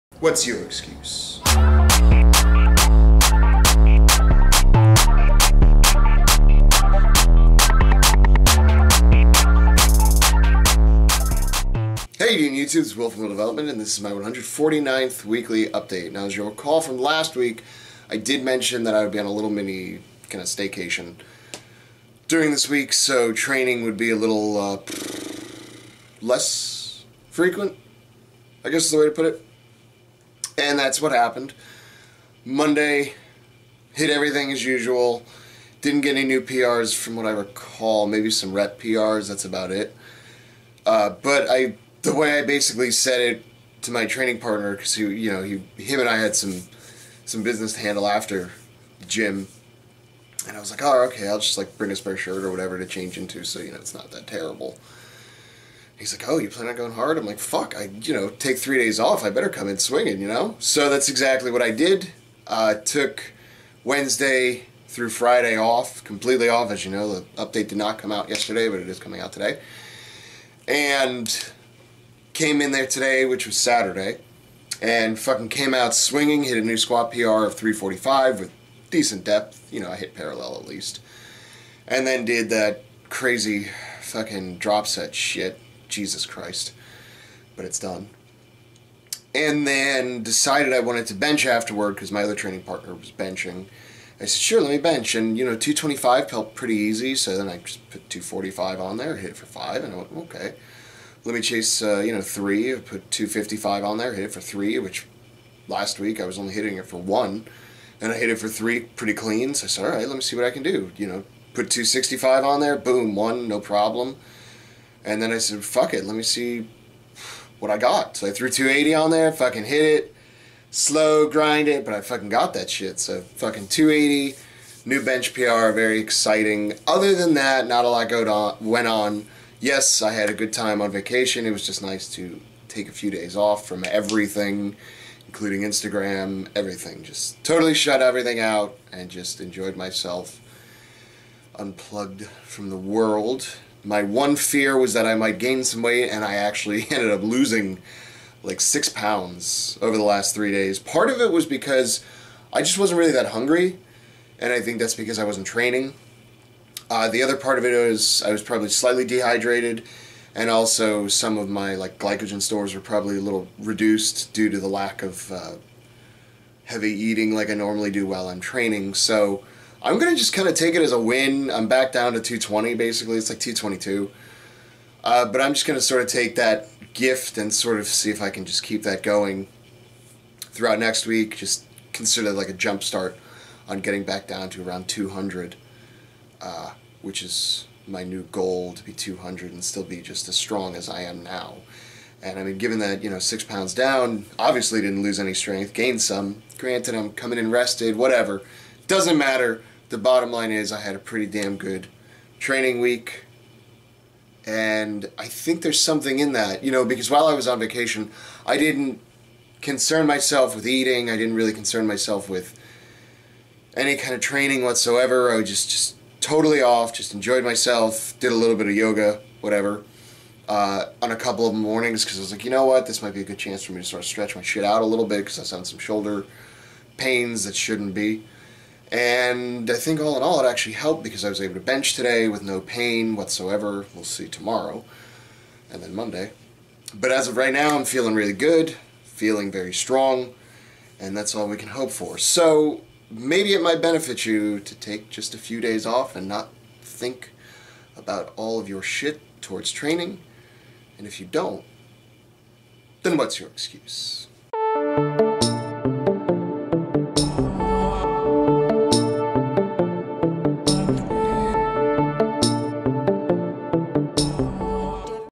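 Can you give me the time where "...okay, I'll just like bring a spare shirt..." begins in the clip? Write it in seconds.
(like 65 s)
51 s.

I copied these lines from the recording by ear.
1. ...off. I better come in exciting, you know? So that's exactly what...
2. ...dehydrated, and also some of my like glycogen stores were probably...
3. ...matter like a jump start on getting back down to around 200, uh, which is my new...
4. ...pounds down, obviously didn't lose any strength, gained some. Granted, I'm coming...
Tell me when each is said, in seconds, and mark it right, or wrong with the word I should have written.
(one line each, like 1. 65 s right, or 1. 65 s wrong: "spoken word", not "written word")
1. 58 s wrong: "swinging", not "exciting"
2. 159 s right
3. 181 s wrong: "consider", not "matter"
4. 193 s right.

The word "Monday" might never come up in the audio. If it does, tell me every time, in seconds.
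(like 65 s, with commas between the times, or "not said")
32 s, 235 s.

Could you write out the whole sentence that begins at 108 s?
And I hit it for three pretty clean.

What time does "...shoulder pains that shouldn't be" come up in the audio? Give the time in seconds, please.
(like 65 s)
225 s.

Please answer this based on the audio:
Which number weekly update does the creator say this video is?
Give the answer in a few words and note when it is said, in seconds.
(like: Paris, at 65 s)
149th, at 14 s.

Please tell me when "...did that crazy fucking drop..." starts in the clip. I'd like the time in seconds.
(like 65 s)
82 s.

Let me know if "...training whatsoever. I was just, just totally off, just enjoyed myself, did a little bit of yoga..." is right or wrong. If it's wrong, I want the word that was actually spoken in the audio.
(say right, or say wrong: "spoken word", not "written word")
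right.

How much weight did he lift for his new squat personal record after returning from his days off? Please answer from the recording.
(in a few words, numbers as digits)
345.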